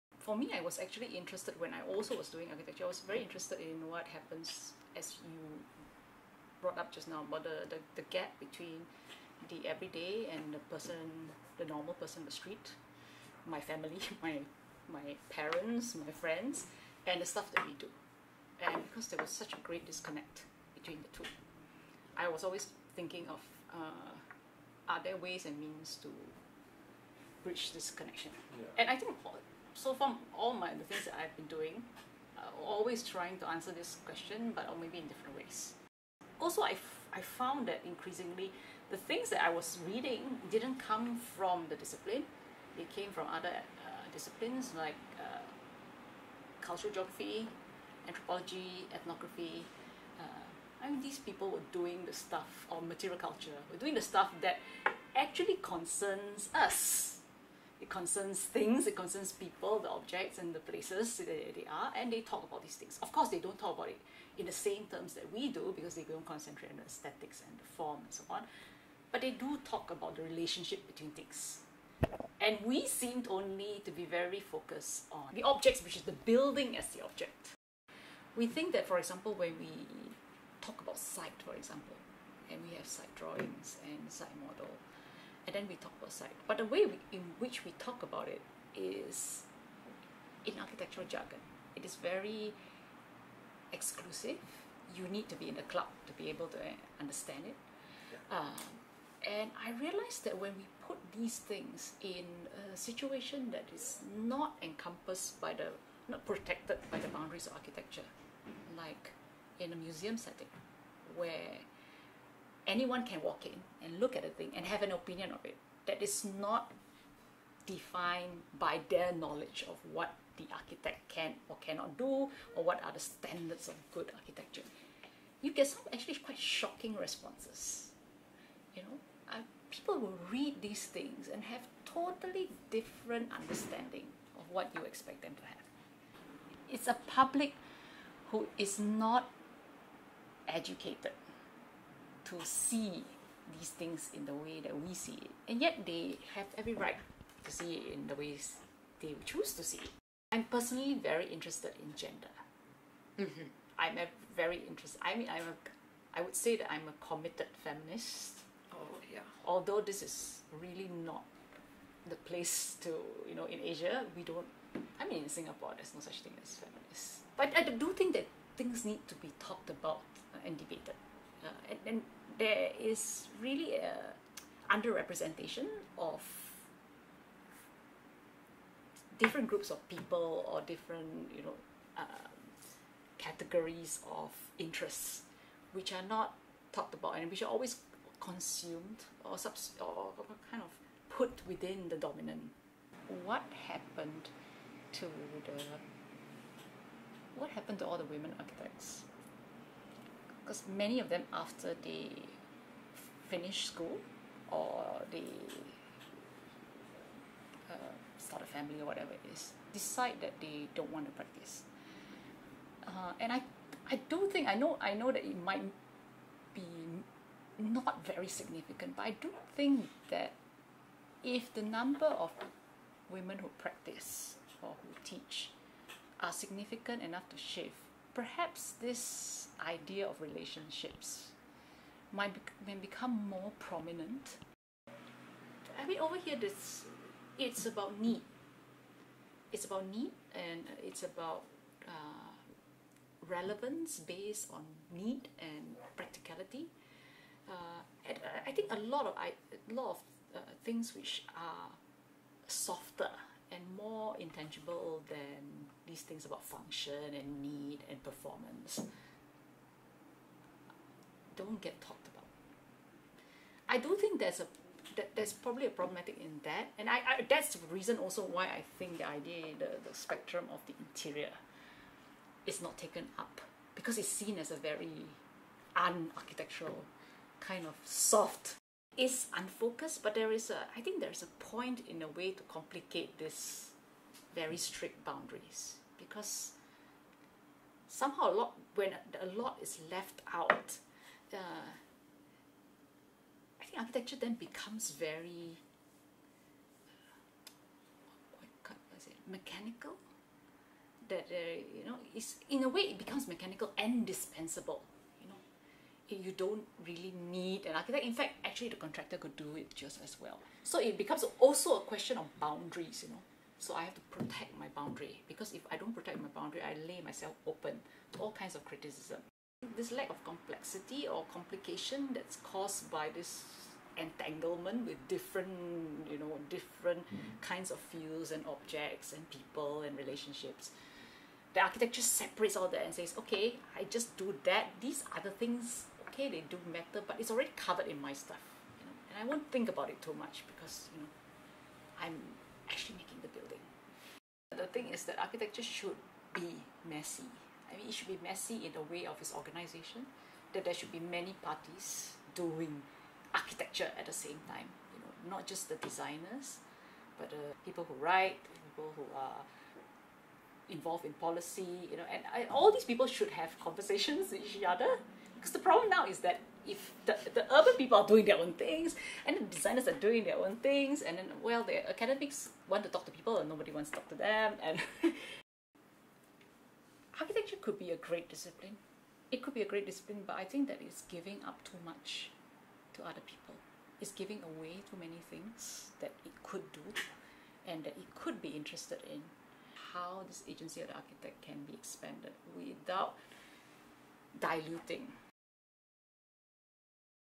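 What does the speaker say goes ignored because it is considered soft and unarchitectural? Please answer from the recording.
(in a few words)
the interior.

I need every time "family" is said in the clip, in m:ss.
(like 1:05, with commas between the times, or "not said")
0:13, 3:28.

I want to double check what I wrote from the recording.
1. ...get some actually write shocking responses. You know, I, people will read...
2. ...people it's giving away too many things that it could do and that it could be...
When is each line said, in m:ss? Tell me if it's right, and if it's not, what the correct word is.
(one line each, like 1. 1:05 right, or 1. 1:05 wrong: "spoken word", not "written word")
1. 2:05 wrong: "quite", not "write"
2. 6:23 right.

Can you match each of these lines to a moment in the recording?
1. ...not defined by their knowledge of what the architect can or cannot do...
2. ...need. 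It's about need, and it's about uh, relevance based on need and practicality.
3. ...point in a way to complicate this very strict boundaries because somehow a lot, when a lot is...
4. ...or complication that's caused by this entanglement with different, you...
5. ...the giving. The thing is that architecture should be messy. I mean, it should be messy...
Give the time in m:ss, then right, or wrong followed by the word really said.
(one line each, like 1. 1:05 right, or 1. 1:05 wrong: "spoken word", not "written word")
1. 1:56 right
2. 3:57 right
3. 4:41 right
4. 5:21 right
5. 5:43 wrong: "building", not "giving".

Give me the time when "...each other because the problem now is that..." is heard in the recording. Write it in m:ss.
6:04.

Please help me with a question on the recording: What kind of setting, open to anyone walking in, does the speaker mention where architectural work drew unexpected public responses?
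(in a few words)
museum.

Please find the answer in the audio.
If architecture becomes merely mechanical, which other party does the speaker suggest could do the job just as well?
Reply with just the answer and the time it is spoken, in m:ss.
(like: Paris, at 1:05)
the contractor, at 5:08.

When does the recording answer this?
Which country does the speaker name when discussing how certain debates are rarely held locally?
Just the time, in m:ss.
2:45.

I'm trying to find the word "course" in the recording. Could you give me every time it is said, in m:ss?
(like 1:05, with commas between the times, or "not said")
1:03.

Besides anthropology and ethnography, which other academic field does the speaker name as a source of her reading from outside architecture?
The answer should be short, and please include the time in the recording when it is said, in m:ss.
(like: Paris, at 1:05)
cultural geography, at 0:46.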